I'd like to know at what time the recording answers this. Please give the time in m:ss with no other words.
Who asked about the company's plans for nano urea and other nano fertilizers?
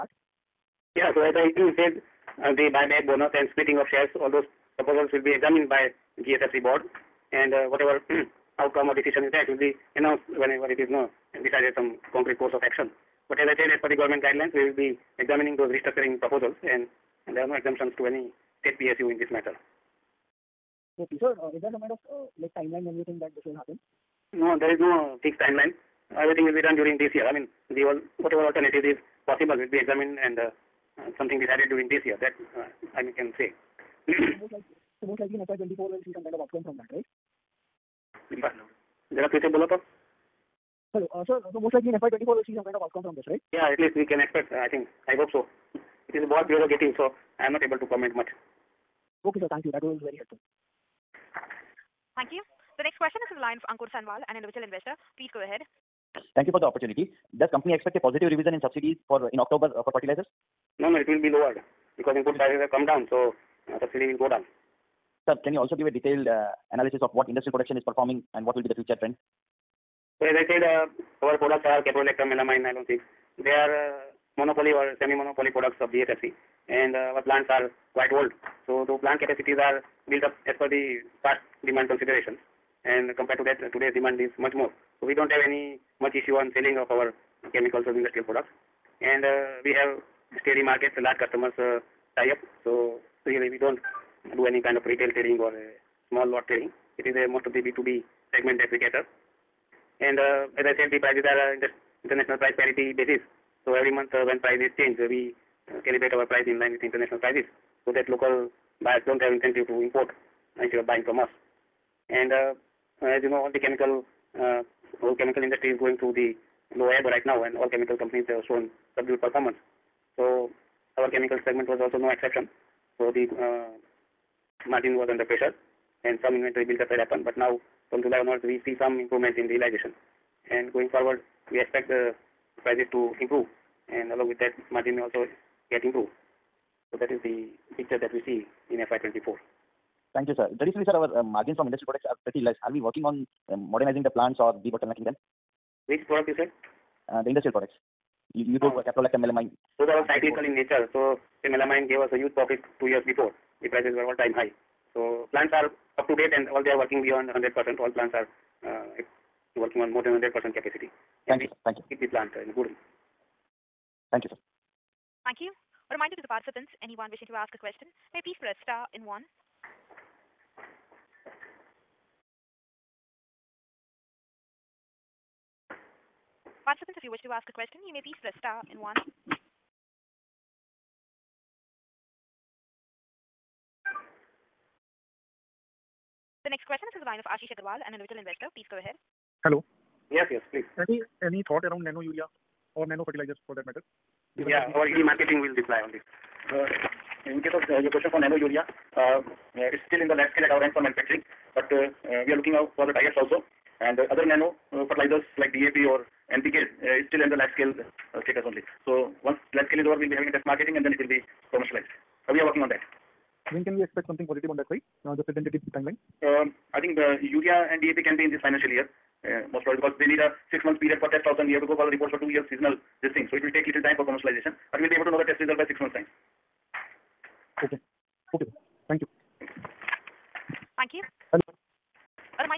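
3:07.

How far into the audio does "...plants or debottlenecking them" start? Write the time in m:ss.
2:24.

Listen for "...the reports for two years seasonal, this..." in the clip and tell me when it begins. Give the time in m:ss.
3:41.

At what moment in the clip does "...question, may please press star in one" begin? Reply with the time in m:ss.
2:47.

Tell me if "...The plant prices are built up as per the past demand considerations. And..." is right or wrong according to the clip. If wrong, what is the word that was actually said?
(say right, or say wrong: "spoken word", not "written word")
wrong: "capacities", not "prices".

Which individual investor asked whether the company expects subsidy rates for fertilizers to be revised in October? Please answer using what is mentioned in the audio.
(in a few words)
Ankur Sanwal.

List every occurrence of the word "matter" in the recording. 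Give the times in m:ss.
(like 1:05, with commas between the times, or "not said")
0:19, 3:13.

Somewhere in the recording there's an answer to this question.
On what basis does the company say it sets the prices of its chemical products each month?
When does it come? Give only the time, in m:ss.
1:42.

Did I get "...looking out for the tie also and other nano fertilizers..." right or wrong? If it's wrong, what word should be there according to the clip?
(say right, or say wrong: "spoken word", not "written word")
right.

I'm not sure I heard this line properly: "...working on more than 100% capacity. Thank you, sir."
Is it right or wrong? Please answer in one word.
right.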